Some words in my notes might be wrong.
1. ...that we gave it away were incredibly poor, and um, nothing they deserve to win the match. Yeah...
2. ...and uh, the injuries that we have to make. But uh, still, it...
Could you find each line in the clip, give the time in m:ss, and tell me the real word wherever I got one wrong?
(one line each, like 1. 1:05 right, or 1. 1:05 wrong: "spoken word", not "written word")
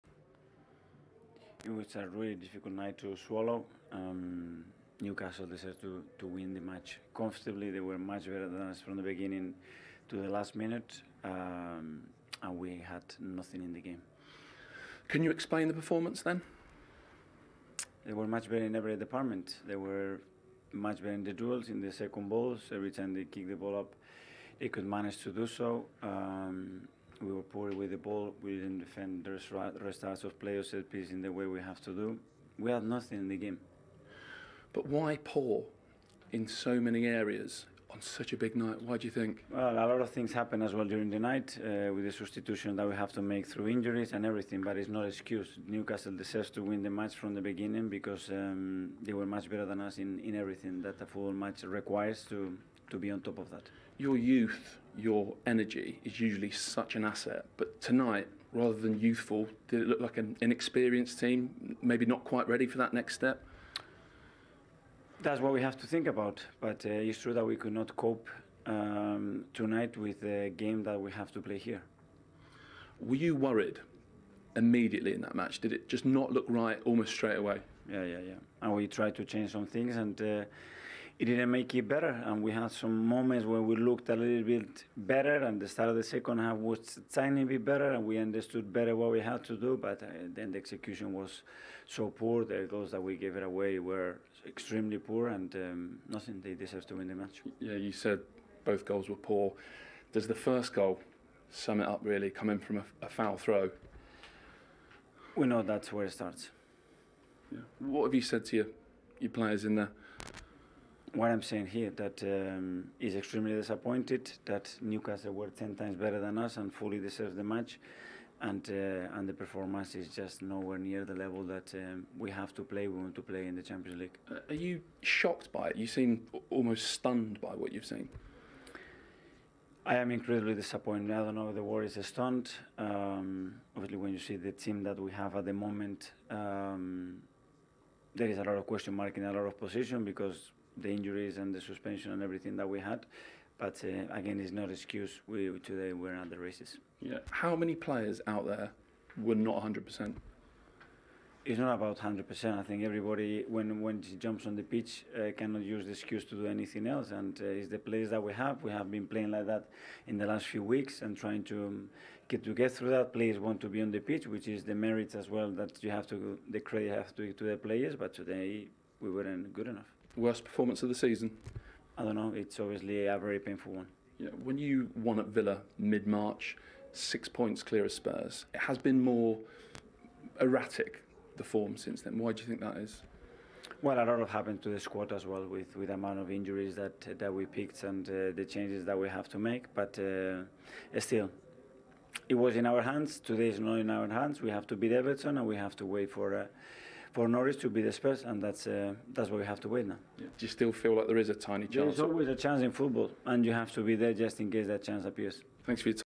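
1. 1:32 wrong: "extremely", not "incredibly"
2. 3:07 wrong: "changes", not "injuries".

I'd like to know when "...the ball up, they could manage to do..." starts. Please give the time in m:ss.
0:23.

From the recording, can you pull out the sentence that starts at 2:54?
Yeah, when you won at Villa mid March, six points clear of Spurs, it has been more erratic, the form since then.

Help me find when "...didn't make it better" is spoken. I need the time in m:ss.
1:21.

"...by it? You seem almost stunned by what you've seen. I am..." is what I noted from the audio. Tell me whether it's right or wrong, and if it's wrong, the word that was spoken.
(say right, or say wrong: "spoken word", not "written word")
right.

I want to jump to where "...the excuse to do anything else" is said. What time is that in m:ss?
2:35.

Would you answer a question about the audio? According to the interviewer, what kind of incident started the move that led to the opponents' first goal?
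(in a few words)
Foul throw.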